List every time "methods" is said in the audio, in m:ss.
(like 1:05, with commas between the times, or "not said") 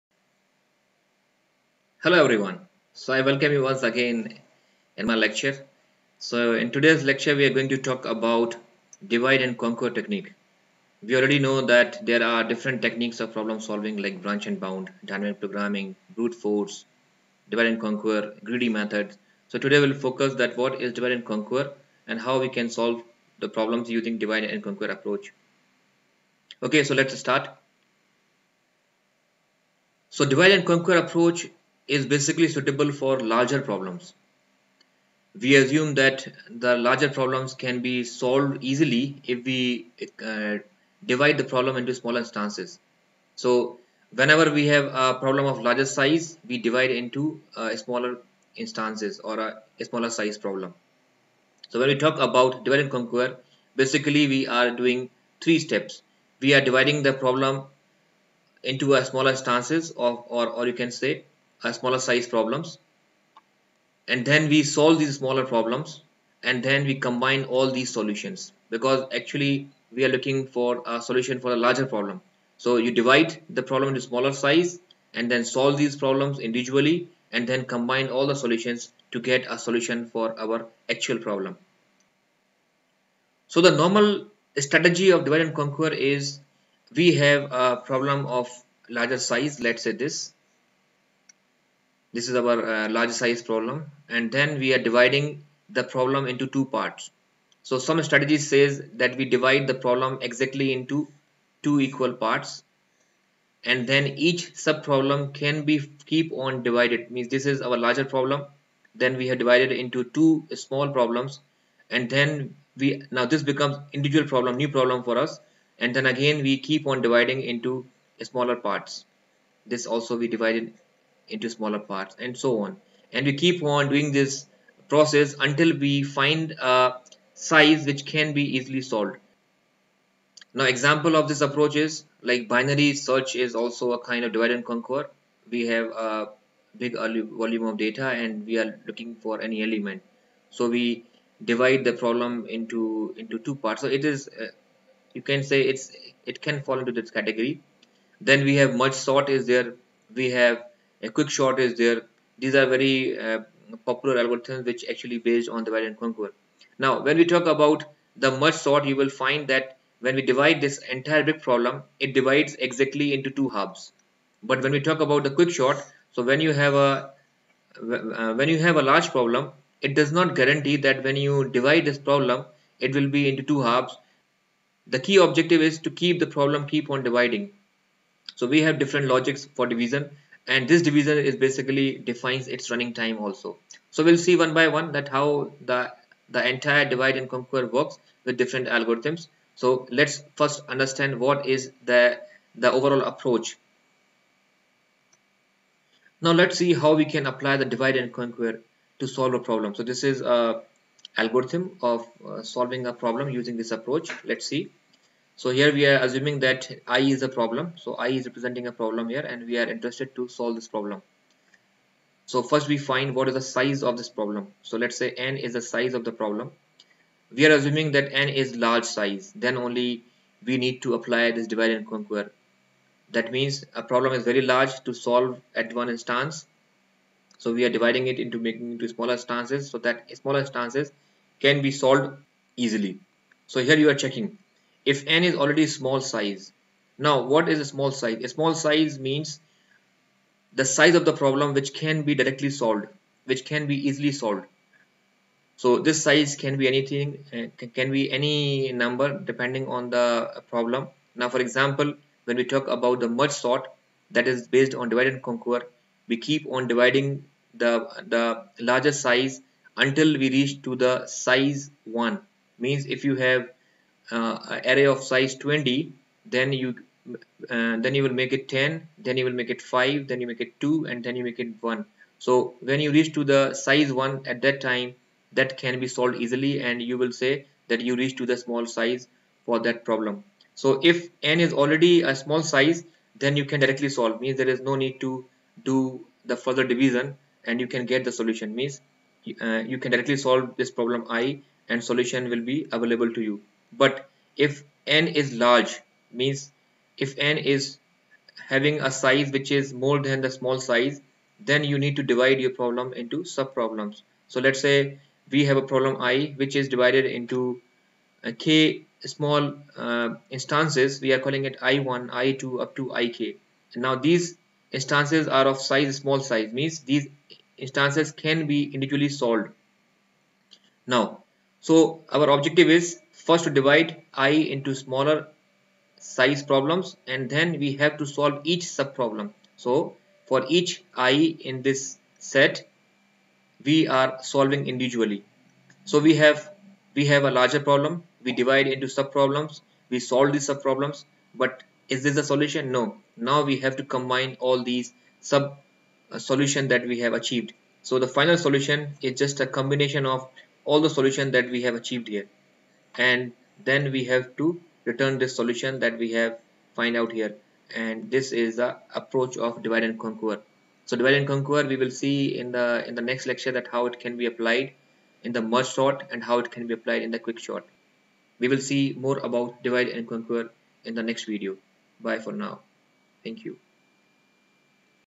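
0:18.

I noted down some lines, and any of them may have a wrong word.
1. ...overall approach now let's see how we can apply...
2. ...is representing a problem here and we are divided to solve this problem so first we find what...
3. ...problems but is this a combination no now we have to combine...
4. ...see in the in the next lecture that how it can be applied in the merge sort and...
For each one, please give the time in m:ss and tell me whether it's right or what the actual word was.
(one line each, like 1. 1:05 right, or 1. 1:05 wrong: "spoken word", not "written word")
1. 3:12 right
2. 3:28 wrong: "interested", not "divided"
3. 5:40 wrong: "solution", not "combination"
4. 6:01 right.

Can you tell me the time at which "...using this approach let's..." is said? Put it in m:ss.
3:23.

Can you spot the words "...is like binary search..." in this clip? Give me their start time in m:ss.
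2:11.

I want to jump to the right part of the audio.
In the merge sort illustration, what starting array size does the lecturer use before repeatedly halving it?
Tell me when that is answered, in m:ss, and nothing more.
4:25.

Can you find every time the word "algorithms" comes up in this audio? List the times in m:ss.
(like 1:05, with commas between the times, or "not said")
2:34, 3:08, 3:21.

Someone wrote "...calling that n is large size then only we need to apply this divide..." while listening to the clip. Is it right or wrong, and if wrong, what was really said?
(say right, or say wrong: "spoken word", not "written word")
wrong: "assuming", not "calling".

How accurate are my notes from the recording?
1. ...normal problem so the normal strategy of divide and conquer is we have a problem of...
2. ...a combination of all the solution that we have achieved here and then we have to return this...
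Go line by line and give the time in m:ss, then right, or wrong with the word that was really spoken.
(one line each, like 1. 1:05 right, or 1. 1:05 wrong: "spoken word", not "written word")
1. 1:20 wrong: "actual", not "normal"
2. 5:49 right.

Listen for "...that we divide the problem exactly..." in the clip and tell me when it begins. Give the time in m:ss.
1:39.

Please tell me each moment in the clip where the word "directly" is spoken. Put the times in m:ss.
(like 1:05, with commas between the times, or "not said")
4:02, 4:43, 4:49.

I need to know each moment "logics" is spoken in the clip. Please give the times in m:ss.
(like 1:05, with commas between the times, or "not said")
2:59.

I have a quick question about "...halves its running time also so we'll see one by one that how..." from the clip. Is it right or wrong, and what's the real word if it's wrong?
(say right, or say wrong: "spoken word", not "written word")
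wrong: "defines", not "halves".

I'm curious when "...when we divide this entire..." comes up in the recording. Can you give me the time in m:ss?
2:39.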